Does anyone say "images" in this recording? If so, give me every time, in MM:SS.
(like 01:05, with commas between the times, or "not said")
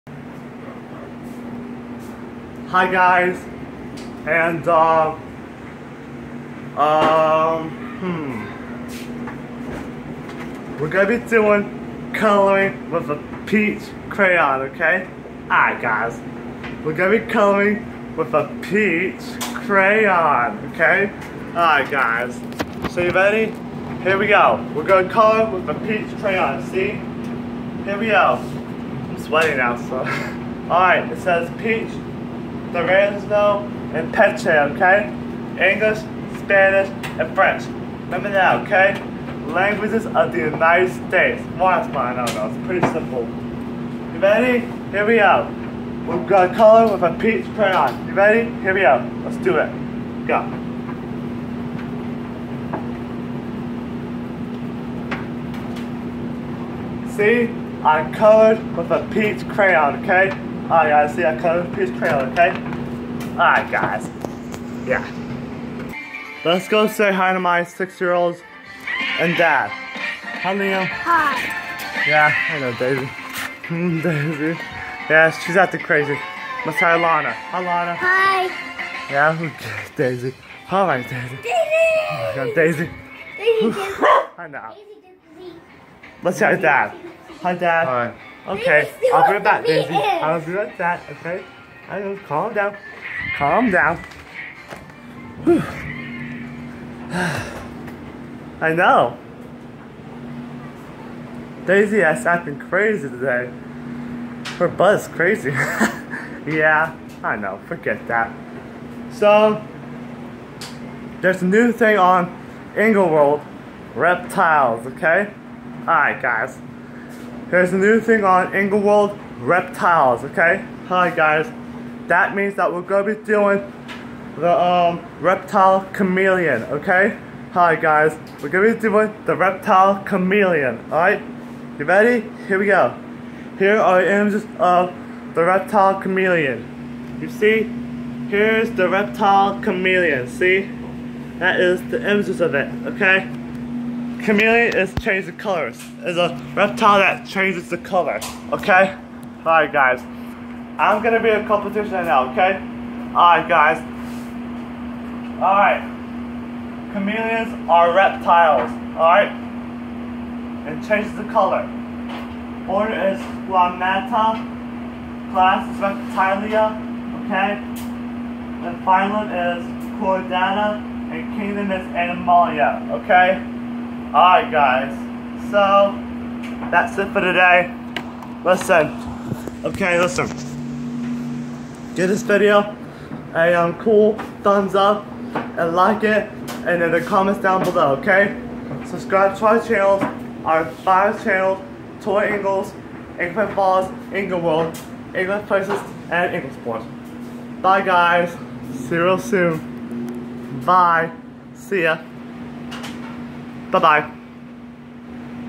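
02:14, 02:22.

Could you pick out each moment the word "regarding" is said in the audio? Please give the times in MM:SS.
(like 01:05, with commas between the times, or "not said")
not said.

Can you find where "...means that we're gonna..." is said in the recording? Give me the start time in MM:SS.
02:02.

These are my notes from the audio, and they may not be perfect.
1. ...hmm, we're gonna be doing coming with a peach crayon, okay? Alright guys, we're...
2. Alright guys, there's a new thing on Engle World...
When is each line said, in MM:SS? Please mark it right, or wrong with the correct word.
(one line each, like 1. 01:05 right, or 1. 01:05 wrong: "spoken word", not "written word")
1. 00:07 wrong: "coloring", not "coming"
2. 01:55 right.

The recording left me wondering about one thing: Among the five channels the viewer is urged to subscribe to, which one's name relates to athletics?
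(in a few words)
Engle Sports.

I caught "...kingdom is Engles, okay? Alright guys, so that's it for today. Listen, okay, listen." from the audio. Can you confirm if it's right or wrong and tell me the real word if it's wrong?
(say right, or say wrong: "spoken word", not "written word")
wrong: "Animalia", not "Engles".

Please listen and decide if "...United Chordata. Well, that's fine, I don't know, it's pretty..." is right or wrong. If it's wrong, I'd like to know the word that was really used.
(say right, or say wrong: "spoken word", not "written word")
wrong: "States", not "Chordata".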